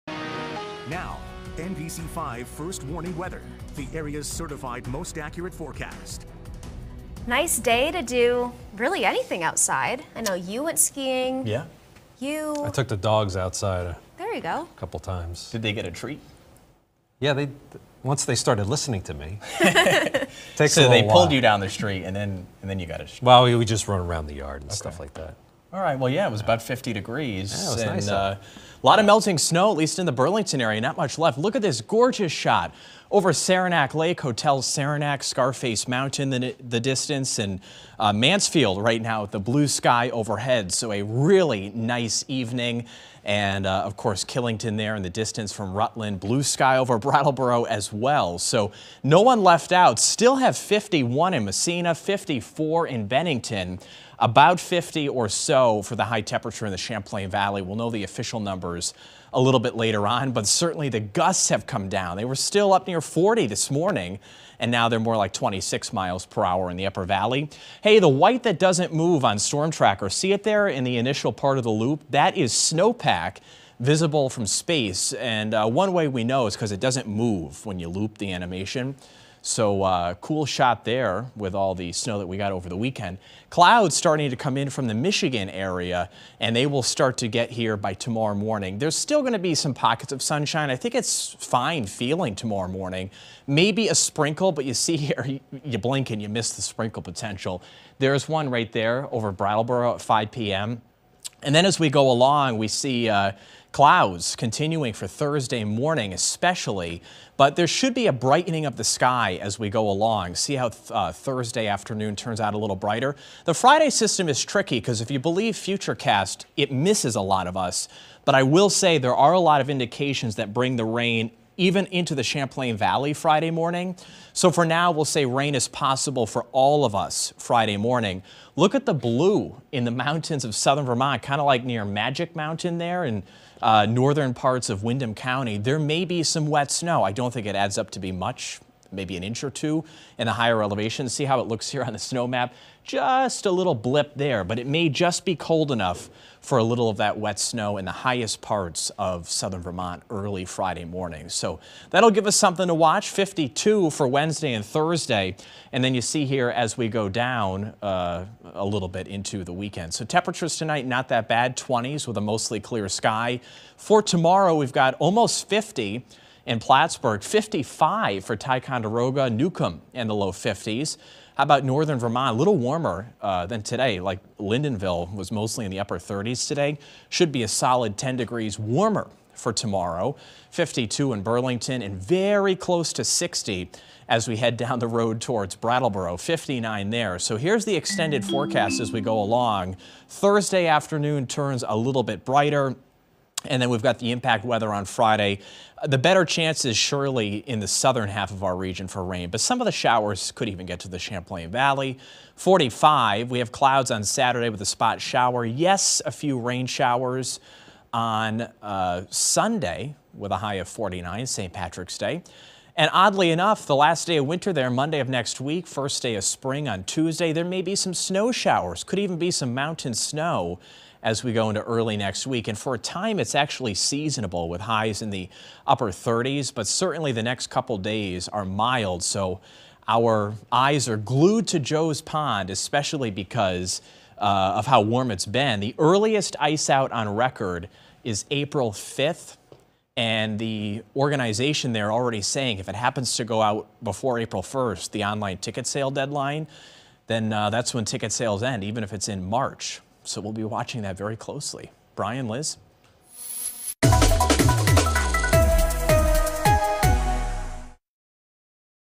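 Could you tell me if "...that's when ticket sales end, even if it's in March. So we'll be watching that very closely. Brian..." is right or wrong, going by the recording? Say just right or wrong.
right.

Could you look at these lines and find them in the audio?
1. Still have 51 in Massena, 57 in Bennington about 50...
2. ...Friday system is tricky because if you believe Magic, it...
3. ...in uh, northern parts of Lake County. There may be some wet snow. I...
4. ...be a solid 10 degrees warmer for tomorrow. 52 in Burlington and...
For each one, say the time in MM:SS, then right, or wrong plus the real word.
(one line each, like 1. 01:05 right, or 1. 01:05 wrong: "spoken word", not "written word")
1. 00:49 wrong: "54", not "57"
2. 01:53 wrong: "Futurecast", not "Magic"
3. 02:13 wrong: "Windham", not "Lake"
4. 02:57 right.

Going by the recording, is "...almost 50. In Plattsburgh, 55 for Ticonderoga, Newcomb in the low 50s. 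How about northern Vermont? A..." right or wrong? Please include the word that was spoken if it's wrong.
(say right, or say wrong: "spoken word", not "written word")
right.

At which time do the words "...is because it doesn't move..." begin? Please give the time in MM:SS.
01:16.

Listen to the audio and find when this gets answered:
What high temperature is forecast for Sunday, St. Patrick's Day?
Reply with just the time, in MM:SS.
03:30.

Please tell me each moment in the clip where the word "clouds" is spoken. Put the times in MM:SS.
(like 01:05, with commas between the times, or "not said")
01:23, 01:43, 03:23.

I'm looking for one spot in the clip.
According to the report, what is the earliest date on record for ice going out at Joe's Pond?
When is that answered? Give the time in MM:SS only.
03:58.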